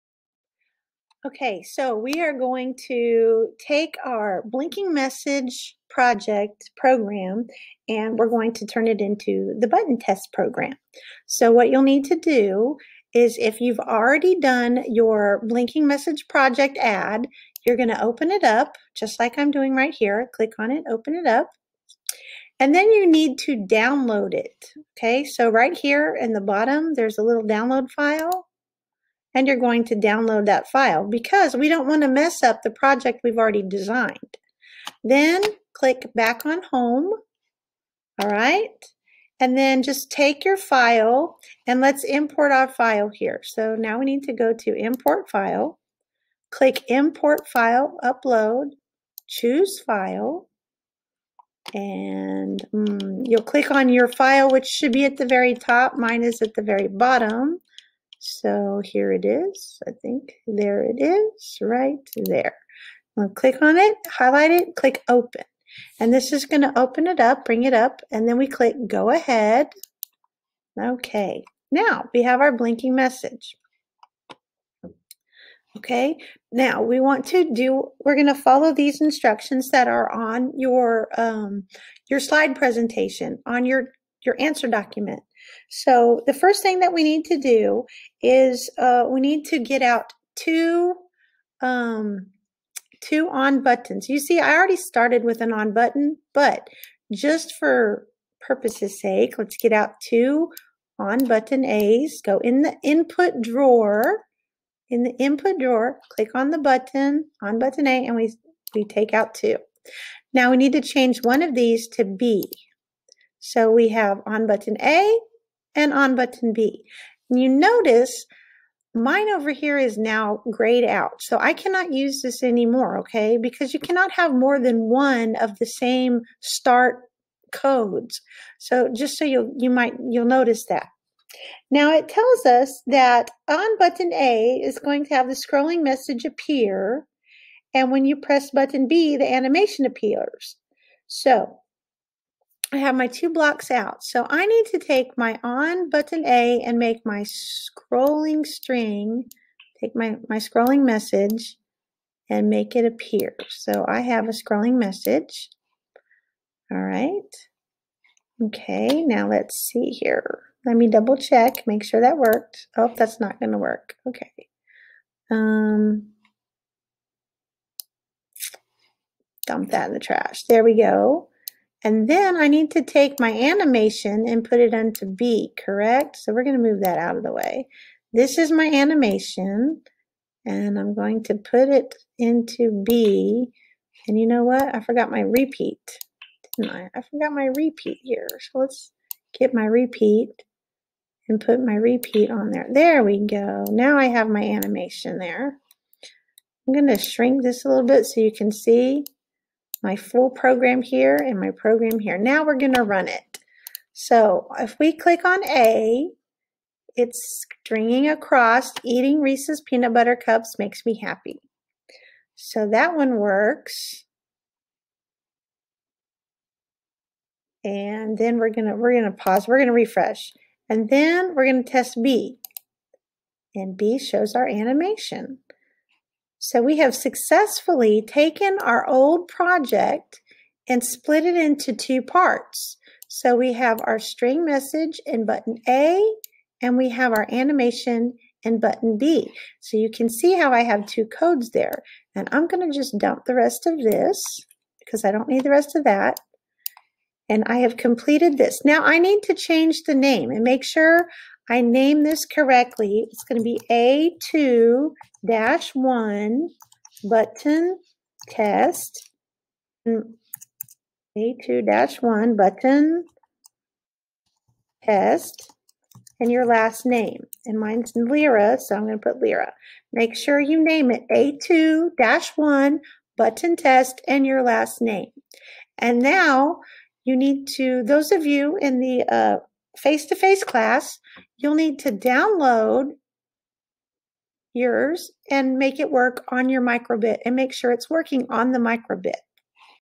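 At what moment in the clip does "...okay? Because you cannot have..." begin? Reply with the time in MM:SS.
02:02.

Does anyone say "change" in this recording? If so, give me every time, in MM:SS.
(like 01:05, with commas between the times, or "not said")
01:50, 04:09.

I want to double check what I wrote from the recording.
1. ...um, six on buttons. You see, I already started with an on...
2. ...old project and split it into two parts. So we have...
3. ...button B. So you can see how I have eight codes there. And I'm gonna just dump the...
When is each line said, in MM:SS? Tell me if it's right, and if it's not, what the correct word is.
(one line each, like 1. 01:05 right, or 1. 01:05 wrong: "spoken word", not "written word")
1. 01:31 wrong: "two", not "six"
2. 03:48 right
3. 03:58 wrong: "two", not "eight".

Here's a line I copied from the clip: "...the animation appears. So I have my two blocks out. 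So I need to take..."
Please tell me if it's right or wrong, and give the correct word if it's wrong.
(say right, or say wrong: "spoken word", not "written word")
right.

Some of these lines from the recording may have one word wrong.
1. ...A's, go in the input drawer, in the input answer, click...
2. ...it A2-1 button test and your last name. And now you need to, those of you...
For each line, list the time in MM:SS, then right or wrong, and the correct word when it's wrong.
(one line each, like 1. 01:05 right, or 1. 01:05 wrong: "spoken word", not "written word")
1. 01:41 wrong: "drawer", not "answer"
2. 04:30 right.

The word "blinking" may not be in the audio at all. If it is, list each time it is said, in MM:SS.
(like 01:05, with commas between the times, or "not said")
00:04, 00:15, 01:12.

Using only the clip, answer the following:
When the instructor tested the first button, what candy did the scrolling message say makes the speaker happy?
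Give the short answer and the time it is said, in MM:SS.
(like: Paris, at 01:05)
Reese's peanut butter cups, at 03:29.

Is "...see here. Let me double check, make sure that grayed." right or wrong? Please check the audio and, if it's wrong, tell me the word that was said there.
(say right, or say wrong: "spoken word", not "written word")
wrong: "worked", not "grayed".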